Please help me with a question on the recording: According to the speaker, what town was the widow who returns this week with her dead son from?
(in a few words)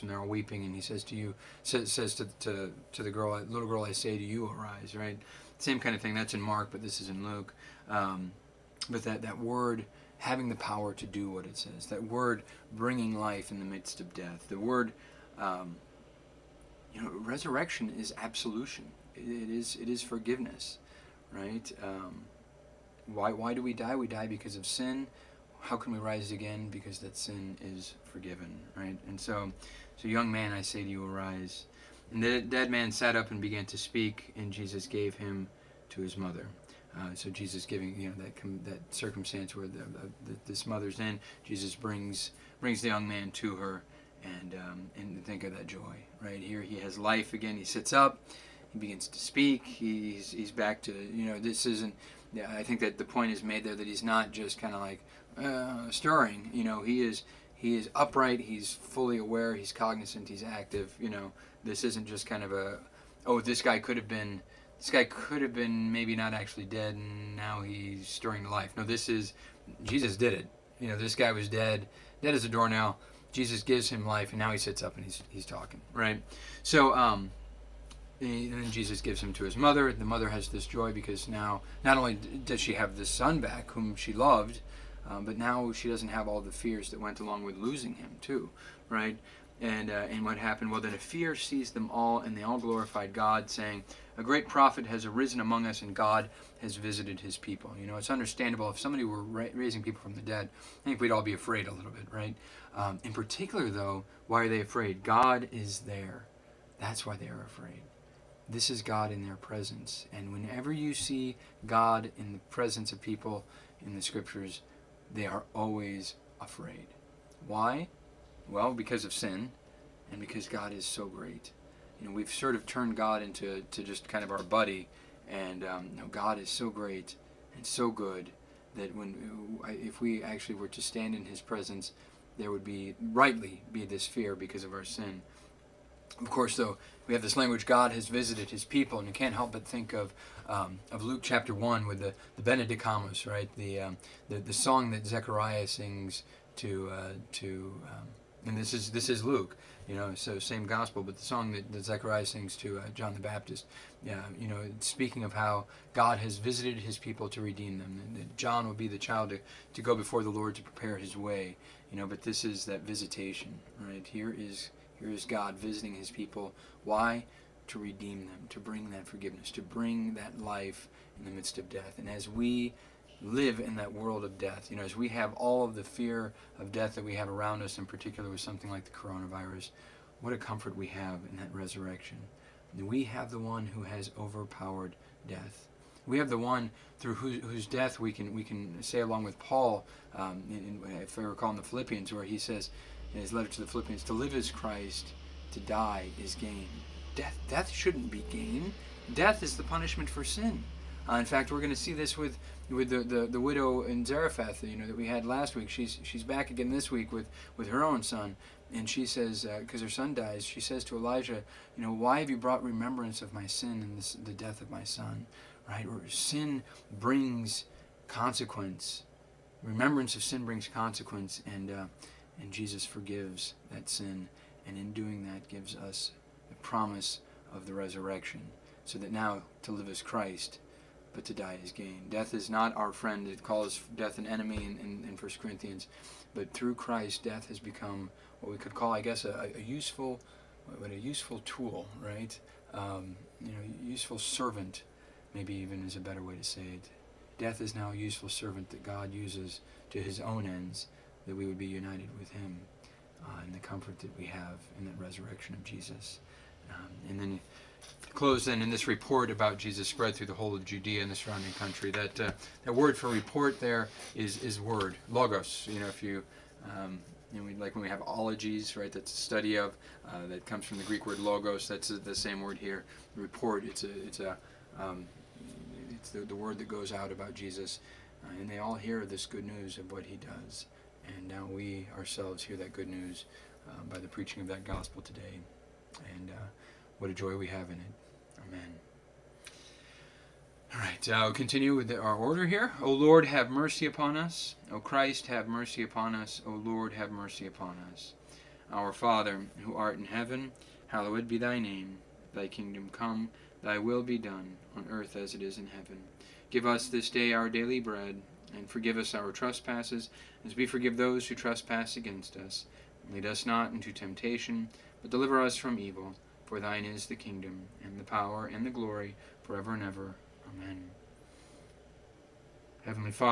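Zarephath.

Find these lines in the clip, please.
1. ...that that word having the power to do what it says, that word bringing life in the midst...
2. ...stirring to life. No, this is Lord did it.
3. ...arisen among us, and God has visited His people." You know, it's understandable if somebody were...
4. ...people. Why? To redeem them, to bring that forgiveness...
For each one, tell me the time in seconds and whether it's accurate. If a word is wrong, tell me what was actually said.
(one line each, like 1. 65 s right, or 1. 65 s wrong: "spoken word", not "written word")
1. 9 s right
2. 68 s wrong: "Jesus", not "Lord"
3. 95 s right
4. 166 s right.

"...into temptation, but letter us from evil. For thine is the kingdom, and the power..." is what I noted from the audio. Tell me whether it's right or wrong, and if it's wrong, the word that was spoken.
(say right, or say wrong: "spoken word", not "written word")
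wrong: "deliver", not "letter".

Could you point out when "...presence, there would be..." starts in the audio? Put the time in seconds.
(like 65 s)
131 s.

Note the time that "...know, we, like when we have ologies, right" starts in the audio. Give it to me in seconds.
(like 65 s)
267 s.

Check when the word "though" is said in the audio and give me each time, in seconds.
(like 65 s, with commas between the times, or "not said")
103 s, 136 s.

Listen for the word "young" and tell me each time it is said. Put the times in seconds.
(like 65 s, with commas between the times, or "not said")
30 s, 42 s.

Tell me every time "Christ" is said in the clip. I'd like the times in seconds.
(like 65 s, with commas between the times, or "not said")
194 s, 230 s, 236 s, 294 s.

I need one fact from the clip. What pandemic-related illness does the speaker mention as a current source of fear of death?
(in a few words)
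coronavirus.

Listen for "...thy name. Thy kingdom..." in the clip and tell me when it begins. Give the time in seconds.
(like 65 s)
301 s.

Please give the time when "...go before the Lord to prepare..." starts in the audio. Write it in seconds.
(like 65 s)
159 s.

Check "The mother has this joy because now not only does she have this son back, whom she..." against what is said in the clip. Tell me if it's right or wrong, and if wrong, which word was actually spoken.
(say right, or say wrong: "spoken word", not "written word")
right.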